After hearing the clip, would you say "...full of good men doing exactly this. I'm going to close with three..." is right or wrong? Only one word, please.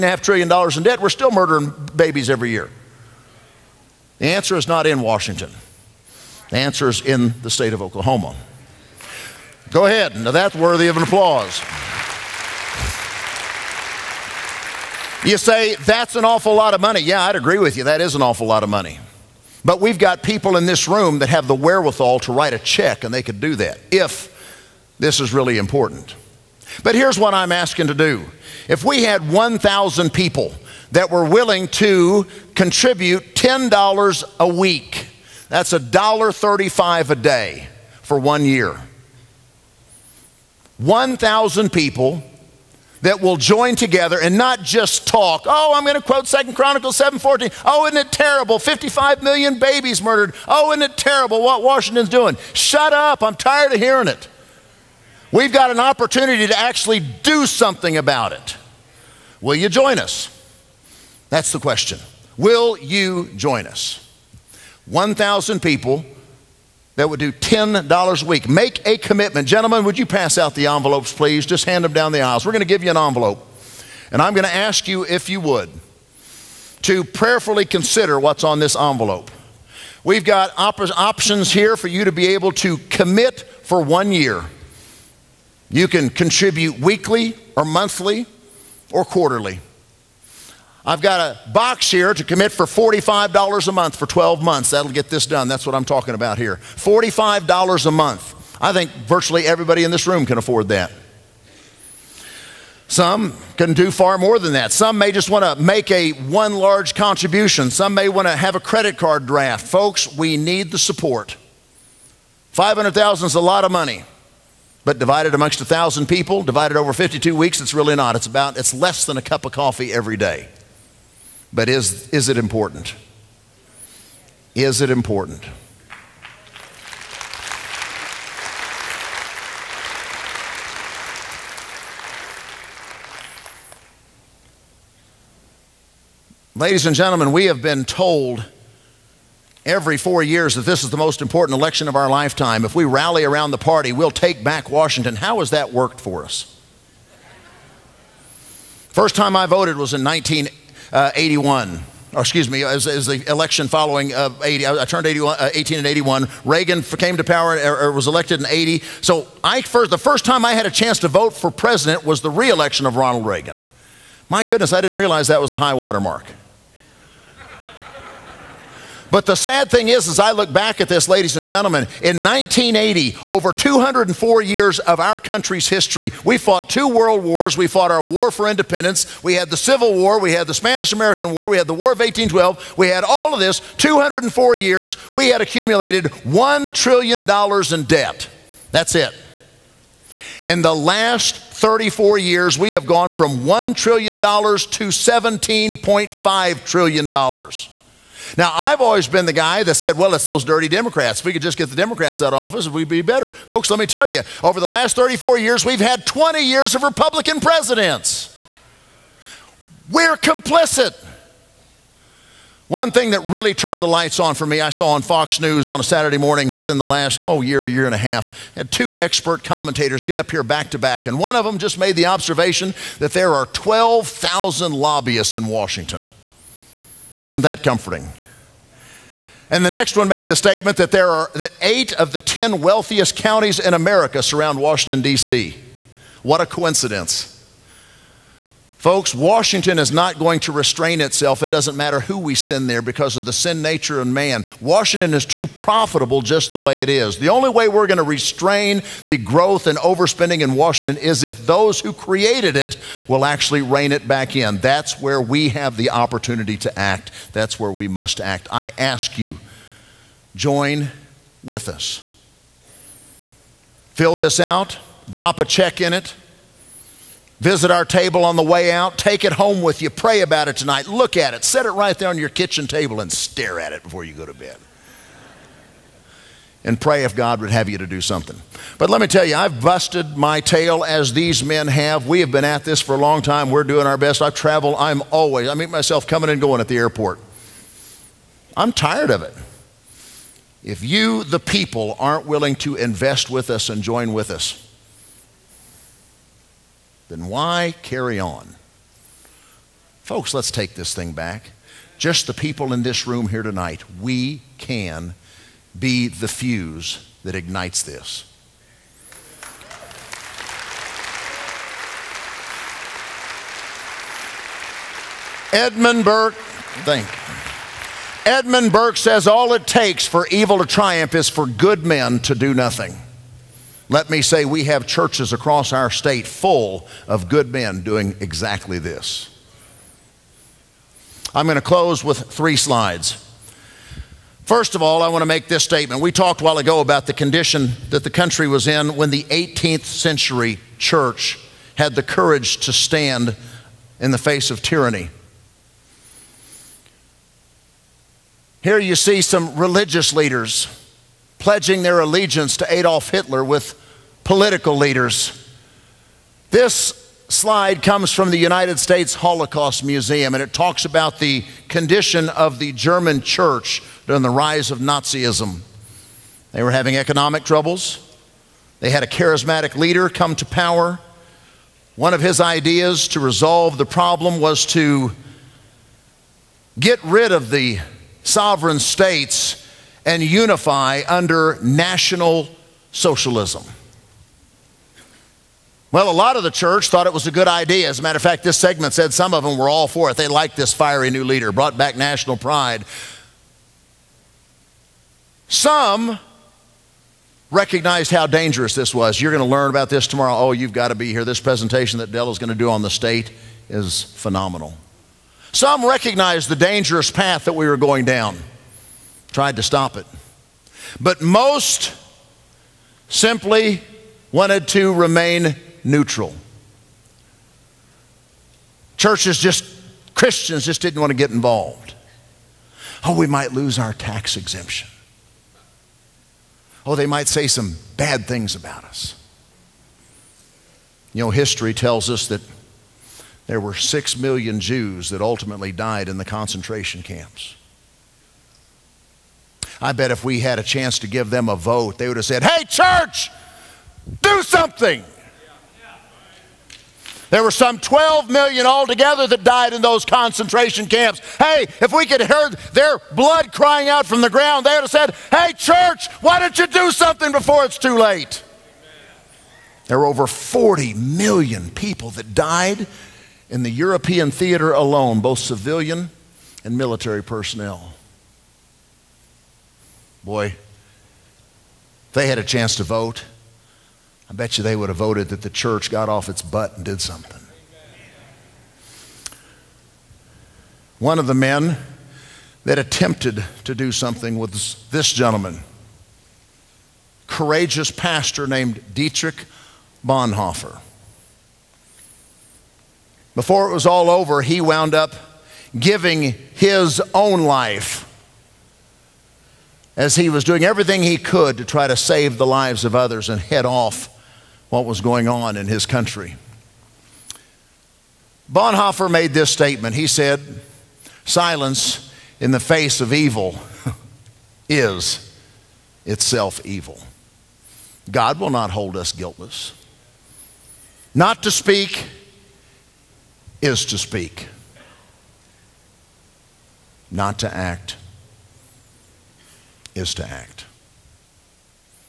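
right.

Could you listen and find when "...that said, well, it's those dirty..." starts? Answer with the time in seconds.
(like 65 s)
199 s.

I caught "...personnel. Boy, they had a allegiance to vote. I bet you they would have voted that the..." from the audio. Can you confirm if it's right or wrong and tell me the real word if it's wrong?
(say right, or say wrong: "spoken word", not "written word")
wrong: "chance", not "allegiance".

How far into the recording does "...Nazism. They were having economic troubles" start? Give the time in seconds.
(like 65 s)
364 s.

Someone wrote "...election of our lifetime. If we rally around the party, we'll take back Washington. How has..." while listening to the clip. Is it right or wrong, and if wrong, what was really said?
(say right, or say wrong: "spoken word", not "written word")
right.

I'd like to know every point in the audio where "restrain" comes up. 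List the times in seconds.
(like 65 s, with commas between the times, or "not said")
240 s, 248 s.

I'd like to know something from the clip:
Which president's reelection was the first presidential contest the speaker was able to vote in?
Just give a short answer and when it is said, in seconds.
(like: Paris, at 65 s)
Ronald Reagan, at 162 s.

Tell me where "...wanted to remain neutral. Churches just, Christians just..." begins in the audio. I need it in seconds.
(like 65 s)
414 s.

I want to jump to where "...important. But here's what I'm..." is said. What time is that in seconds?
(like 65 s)
25 s.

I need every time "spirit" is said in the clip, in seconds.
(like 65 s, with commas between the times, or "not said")
not said.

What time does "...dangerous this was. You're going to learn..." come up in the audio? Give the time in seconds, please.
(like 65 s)
398 s.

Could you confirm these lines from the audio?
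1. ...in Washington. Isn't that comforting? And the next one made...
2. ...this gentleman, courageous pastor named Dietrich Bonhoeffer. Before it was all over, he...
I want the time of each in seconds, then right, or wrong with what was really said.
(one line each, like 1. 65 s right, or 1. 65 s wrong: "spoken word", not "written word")
1. 225 s right
2. 484 s right.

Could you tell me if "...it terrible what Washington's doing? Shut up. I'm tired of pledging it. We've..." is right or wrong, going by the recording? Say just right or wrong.
wrong.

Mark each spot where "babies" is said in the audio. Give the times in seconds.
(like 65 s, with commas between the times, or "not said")
1 s, 49 s.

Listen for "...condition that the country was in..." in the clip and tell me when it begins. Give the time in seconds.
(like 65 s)
337 s.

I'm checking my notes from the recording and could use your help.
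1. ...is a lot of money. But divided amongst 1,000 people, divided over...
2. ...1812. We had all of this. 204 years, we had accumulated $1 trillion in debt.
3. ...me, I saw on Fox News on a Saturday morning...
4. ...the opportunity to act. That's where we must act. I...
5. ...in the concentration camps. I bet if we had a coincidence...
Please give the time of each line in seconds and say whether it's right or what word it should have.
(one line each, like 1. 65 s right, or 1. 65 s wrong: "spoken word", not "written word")
1. 113 s right
2. 181 s right
3. 214 s right
4. 255 s right
5. 436 s wrong: "chance", not "coincidence".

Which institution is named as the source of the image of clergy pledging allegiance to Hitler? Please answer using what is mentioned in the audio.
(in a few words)
United States Holocaust Museum.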